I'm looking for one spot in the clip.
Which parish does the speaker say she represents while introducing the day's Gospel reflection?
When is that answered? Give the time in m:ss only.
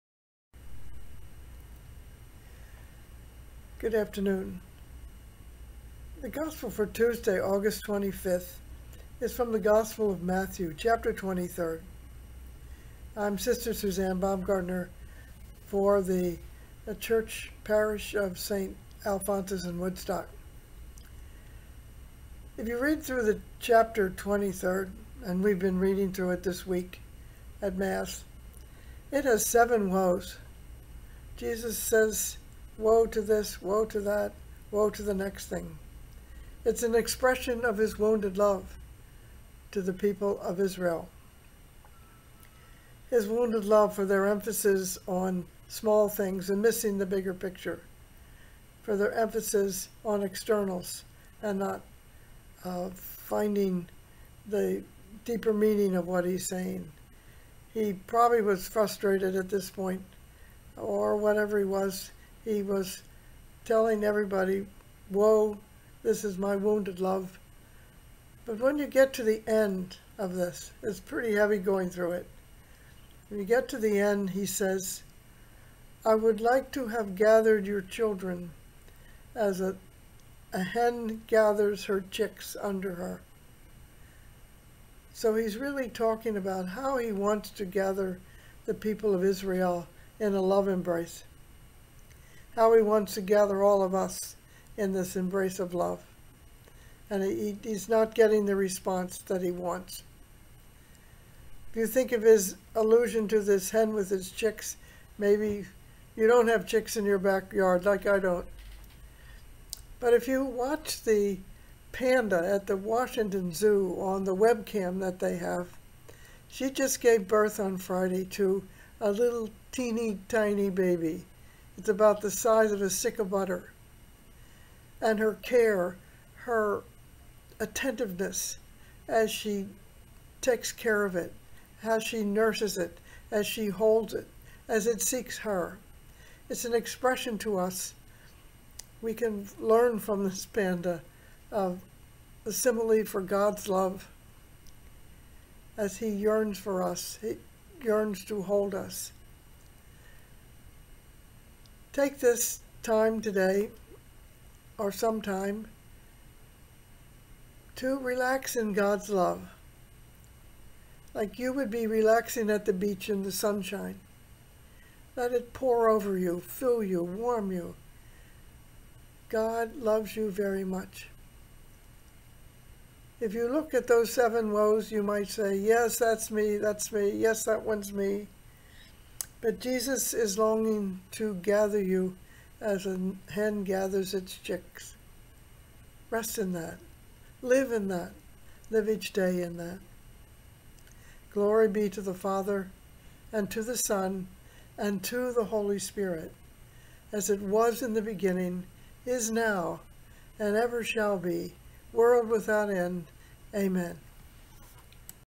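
0:18.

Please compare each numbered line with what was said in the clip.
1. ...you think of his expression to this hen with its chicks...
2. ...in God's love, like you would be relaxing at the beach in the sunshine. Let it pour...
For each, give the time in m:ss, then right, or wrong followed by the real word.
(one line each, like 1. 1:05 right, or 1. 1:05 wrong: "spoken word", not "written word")
1. 1:41 wrong: "allusion", not "expression"
2. 2:38 right.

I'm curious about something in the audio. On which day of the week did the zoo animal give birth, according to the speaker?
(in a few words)
Friday.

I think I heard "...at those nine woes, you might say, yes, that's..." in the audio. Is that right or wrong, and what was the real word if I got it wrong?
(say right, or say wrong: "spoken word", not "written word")
wrong: "seven", not "nine".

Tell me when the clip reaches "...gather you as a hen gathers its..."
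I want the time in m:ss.
3:01.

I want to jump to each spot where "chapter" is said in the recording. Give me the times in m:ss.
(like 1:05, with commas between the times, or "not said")
0:10, 0:23.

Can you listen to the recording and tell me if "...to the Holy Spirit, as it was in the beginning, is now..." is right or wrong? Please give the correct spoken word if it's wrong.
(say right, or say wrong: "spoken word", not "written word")
right.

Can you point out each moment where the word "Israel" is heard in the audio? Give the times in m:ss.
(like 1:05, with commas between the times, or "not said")
0:40, 1:29.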